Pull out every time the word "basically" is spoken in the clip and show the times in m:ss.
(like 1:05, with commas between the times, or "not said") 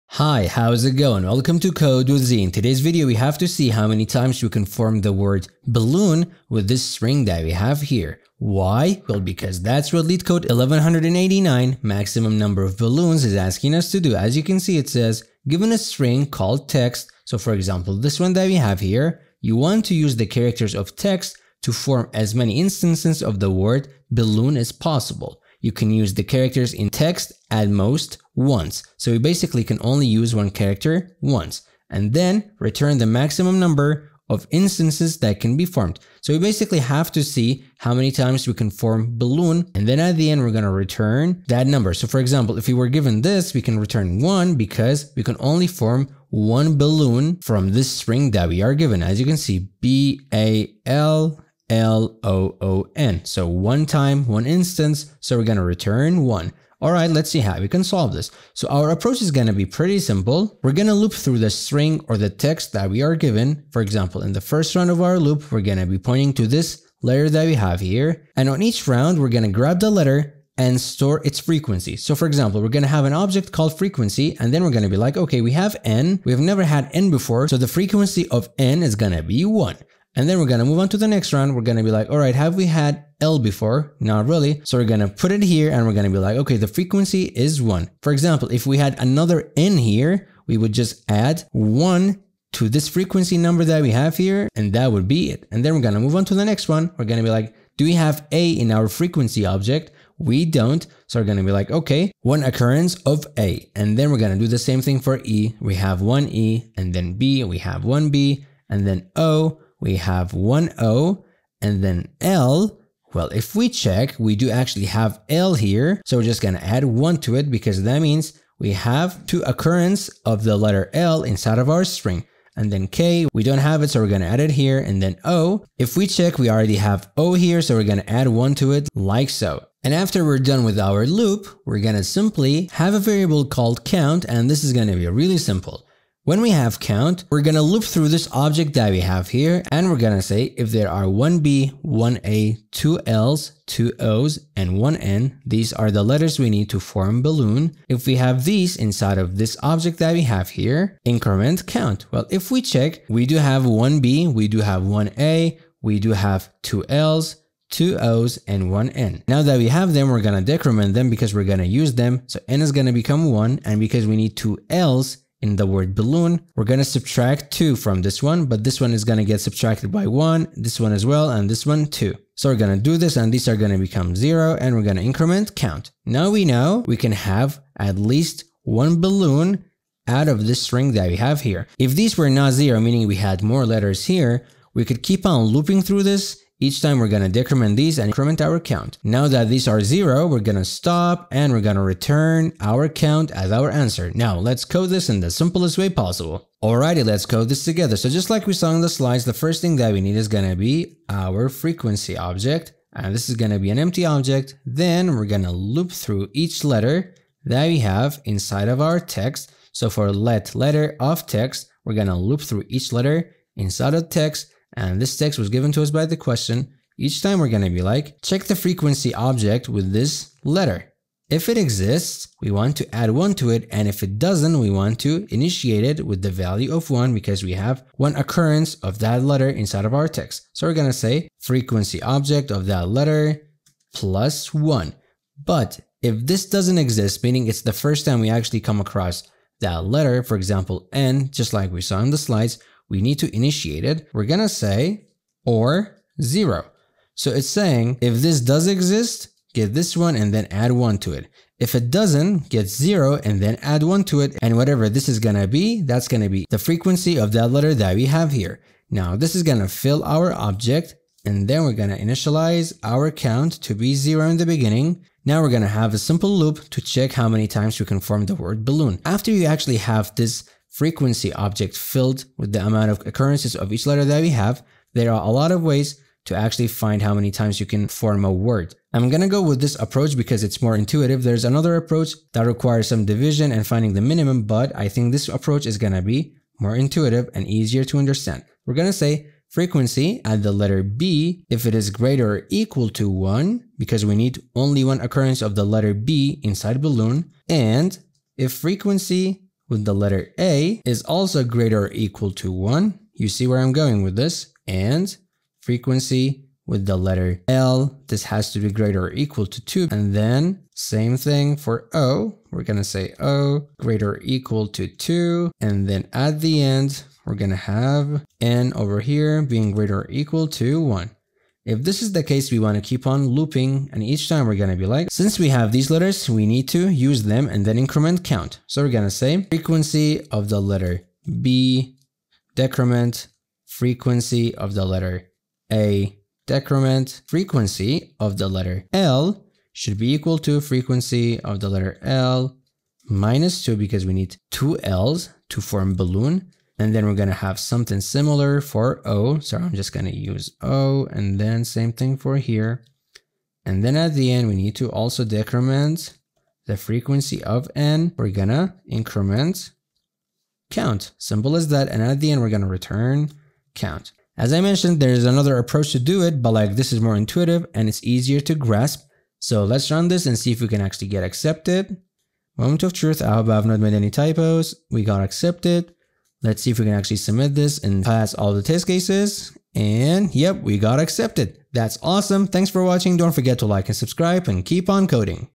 0:29, 0:36.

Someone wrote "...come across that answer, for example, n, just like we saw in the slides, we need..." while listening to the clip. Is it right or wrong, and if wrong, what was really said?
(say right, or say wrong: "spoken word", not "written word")
wrong: "letter", not "answer".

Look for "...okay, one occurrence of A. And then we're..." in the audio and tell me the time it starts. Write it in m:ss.
1:41.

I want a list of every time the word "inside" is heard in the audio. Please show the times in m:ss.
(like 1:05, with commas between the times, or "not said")
2:01, 2:28, 3:28, 3:33, 3:49, 4:56.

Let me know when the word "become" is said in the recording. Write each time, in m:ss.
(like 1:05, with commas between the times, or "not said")
2:42, 2:53.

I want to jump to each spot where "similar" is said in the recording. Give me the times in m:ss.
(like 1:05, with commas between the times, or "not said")
5:48.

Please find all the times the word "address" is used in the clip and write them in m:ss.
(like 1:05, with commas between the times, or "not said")
not said.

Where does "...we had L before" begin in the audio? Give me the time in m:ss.
1:22.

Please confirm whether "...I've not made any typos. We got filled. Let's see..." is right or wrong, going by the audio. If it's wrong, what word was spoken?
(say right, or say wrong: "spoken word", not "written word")
wrong: "accepted", not "filled".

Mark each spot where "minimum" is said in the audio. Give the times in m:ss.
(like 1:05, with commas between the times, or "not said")
4:44.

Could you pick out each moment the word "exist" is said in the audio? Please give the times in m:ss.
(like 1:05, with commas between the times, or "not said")
3:41, 3:56, 4:08.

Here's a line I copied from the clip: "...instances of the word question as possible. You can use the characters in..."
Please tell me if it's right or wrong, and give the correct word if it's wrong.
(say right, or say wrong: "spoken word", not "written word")
wrong: "balloon", not "question".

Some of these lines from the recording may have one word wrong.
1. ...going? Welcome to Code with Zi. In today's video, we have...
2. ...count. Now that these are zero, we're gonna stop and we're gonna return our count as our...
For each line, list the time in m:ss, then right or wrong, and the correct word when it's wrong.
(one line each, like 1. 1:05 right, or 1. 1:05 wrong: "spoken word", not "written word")
1. 0:00 right
2. 3:08 right.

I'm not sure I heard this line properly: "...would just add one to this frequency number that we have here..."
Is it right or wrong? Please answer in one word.
right.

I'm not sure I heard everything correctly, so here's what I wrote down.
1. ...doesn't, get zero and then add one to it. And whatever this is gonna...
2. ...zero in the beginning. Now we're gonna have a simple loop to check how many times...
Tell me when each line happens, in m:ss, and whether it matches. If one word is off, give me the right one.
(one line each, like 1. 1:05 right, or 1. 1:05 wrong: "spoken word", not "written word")
1. 4:11 right
2. 4:23 right.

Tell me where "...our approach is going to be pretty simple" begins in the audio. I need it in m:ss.
0:58.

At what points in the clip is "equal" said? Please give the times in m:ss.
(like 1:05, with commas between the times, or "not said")
4:52, 5:01, 5:09, 5:14, 5:20, 5:40.